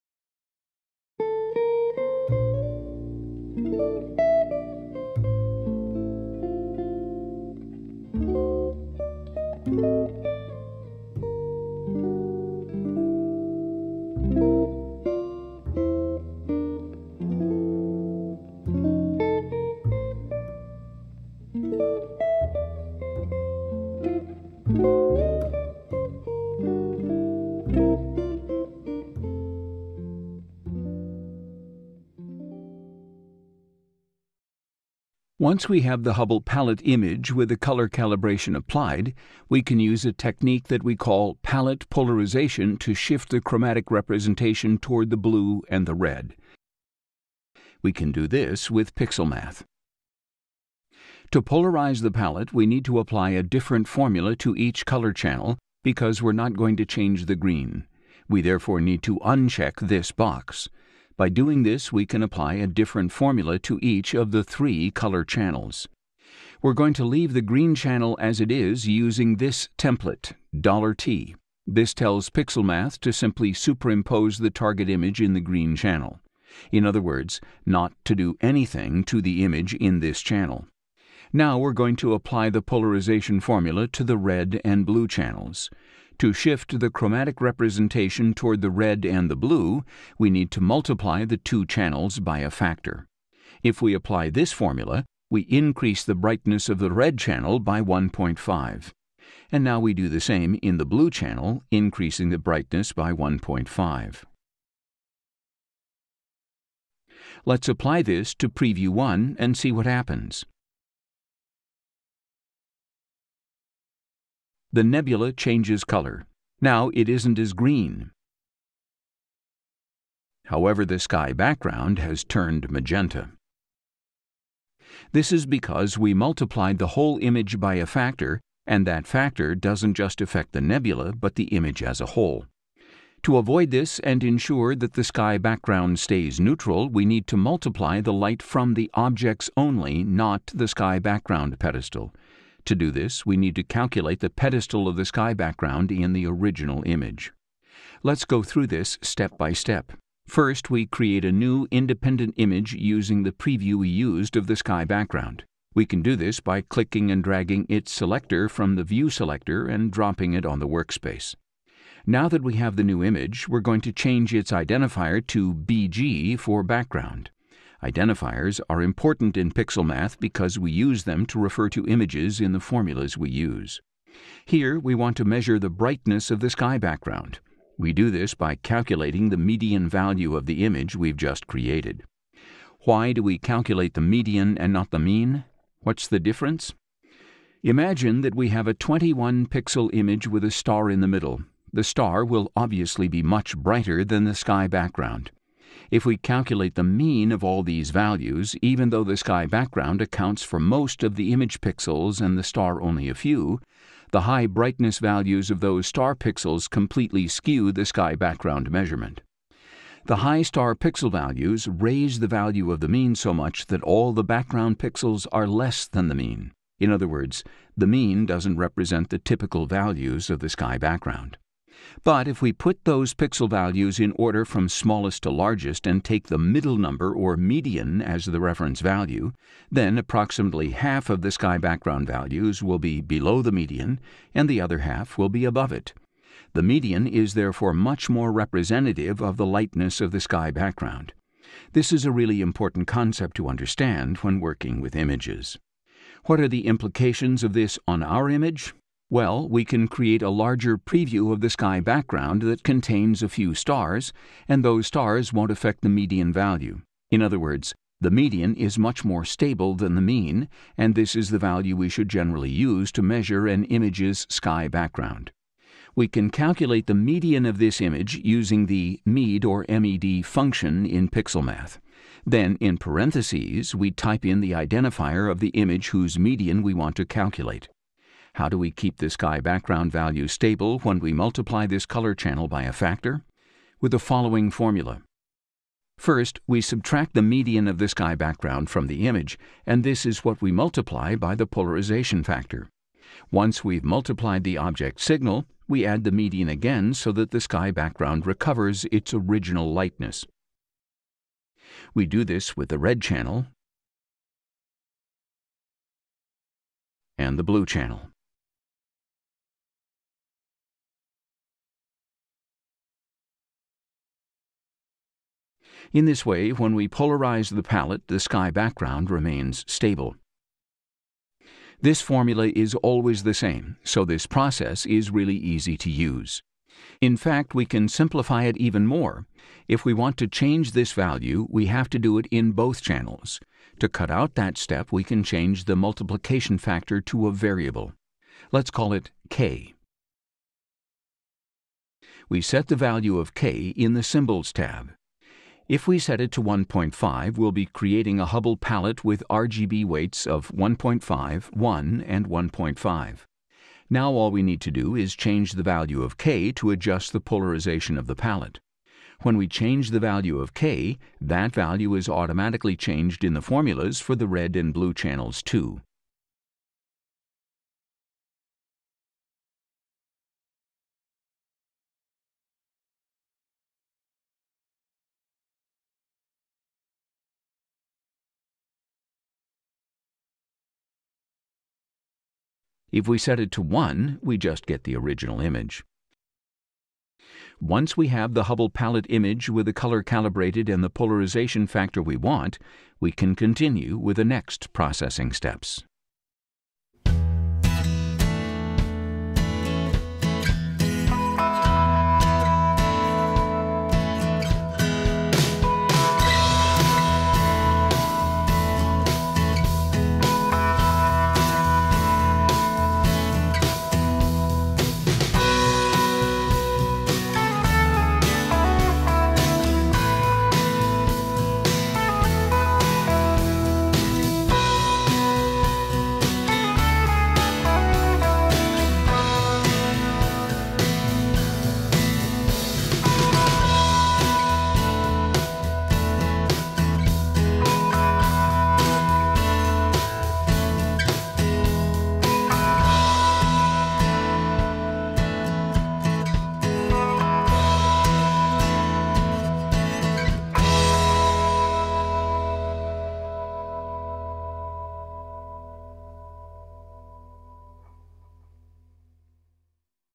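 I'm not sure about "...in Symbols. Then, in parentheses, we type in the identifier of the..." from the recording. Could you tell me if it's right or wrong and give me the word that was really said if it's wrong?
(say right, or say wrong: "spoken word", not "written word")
wrong: "PixelMath", not "Symbols".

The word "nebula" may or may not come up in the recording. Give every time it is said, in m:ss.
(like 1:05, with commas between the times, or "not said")
1:54, 2:10.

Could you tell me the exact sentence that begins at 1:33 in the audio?
If we apply this formula, we increase the brightness of the red channel by 1.5.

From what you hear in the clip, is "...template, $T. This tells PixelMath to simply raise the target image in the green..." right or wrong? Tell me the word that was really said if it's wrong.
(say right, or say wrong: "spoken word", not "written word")
wrong: "superimpose", not "raise".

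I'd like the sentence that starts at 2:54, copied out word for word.
Here we want to measure the brightness of the sky background.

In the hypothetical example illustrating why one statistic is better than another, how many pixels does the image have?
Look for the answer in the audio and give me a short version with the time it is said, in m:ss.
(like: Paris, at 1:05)
21, at 3:08.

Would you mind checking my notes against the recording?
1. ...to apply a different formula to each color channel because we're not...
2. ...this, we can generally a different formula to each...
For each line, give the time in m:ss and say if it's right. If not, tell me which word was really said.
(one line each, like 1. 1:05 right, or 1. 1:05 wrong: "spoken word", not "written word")
1. 0:52 right
2. 1:01 wrong: "apply", not "generally".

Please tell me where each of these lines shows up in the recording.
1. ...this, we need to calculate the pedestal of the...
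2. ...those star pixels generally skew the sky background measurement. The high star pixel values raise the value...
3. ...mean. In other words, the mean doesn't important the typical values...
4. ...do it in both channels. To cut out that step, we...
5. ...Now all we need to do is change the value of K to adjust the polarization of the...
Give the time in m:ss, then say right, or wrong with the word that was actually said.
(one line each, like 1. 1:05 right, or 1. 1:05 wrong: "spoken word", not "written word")
1. 2:22 right
2. 3:25 wrong: "completely", not "generally"
3. 3:36 wrong: "represent", not "important"
4. 5:31 right
5. 5:53 right.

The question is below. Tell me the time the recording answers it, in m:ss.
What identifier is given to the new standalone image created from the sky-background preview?
2:45.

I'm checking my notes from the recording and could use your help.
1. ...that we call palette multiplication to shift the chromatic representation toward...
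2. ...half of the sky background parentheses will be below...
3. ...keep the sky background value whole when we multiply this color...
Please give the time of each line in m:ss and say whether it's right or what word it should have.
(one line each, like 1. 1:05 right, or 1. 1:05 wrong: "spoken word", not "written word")
1. 0:40 wrong: "polarization", not "multiplication"
2. 3:50 wrong: "values", not "parentheses"
3. 4:38 wrong: "stable", not "whole".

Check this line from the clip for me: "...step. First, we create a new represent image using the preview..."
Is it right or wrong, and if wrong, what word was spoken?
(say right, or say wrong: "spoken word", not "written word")
wrong: "independent", not "represent".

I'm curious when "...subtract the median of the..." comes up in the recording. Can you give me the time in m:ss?
4:46.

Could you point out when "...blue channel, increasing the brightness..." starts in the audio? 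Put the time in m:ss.
1:40.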